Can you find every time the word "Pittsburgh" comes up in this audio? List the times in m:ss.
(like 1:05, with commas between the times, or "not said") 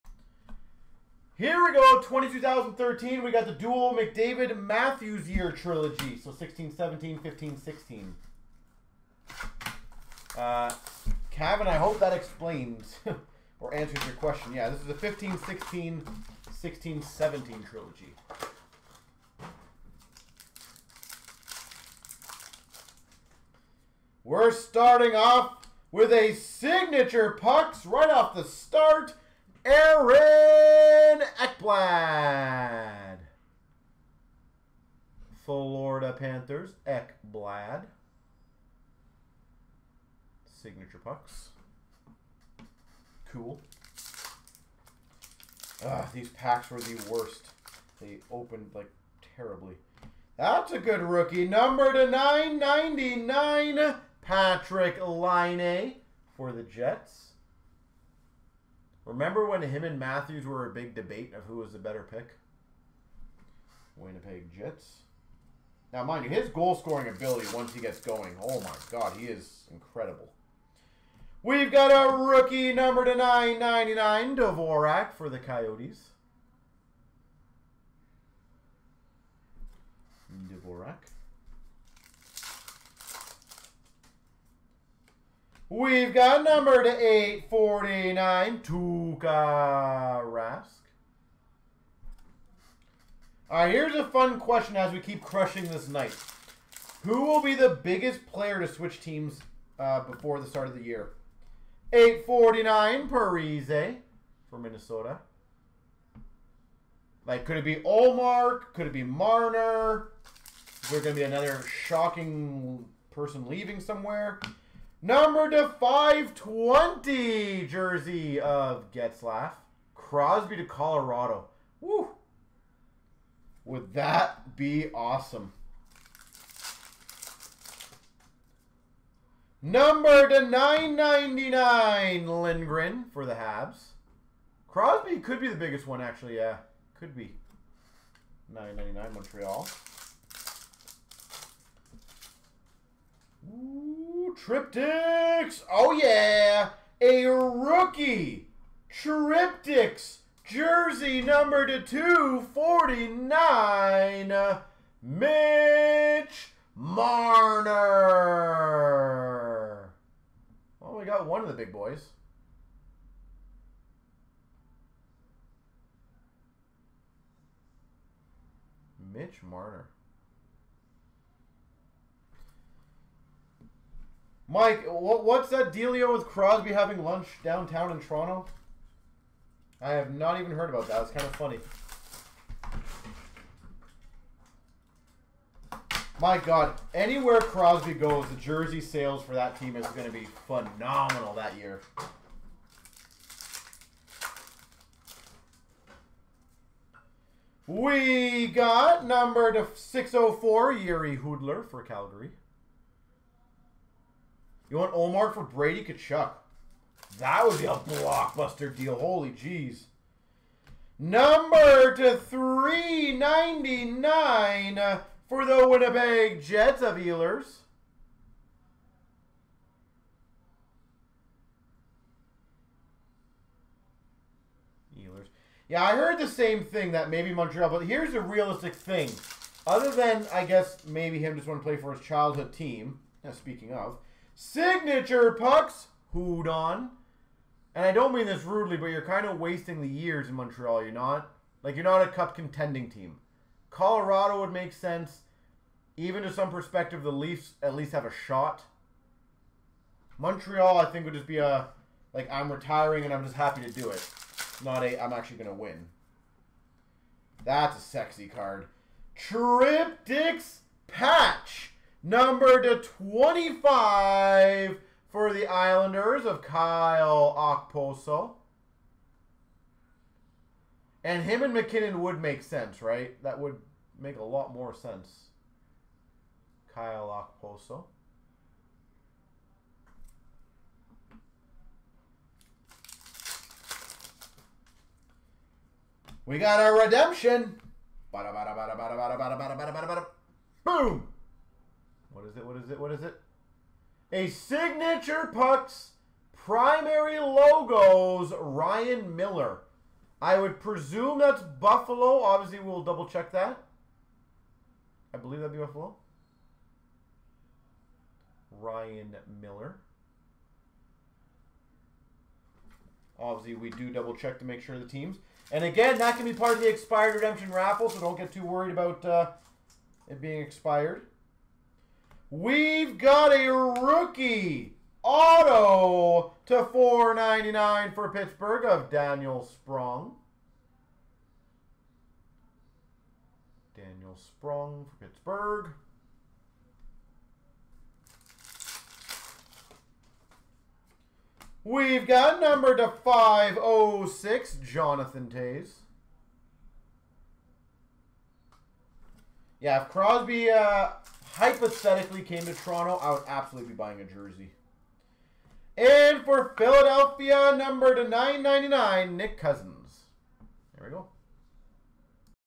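5:28, 5:35.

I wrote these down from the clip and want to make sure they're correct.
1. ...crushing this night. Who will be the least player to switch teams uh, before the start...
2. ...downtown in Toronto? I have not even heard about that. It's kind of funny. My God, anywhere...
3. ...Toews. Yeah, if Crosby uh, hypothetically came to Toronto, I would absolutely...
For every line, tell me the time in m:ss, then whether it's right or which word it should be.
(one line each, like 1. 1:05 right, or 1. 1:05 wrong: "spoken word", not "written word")
1. 1:35 wrong: "biggest", not "least"
2. 2:57 right
3. 5:45 right.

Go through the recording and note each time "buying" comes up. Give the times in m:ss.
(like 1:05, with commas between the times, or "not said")
5:53.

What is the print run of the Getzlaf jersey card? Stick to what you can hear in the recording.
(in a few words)
520.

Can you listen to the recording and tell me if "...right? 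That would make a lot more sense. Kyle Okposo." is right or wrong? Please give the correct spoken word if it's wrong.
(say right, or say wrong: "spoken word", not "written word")
right.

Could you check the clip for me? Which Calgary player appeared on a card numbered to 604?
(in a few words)
Jiri Hudler.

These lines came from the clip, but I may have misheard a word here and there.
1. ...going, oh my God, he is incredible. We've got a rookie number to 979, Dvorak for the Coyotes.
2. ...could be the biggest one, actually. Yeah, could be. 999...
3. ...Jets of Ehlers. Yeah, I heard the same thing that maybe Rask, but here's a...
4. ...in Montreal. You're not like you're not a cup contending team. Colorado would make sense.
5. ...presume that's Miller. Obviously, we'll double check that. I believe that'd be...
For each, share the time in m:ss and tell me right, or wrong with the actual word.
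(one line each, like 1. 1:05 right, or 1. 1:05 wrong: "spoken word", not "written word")
1. 1:07 wrong: "999", not "979"
2. 2:15 right
3. 3:36 wrong: "Montreal", not "Rask"
4. 4:00 right
5. 5:00 wrong: "Buffalo", not "Miller".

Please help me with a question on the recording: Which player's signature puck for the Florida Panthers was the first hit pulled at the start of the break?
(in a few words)
Aaron Ekblad.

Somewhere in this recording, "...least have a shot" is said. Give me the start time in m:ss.
4:07.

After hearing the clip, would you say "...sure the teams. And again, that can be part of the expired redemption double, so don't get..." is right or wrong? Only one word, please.
wrong.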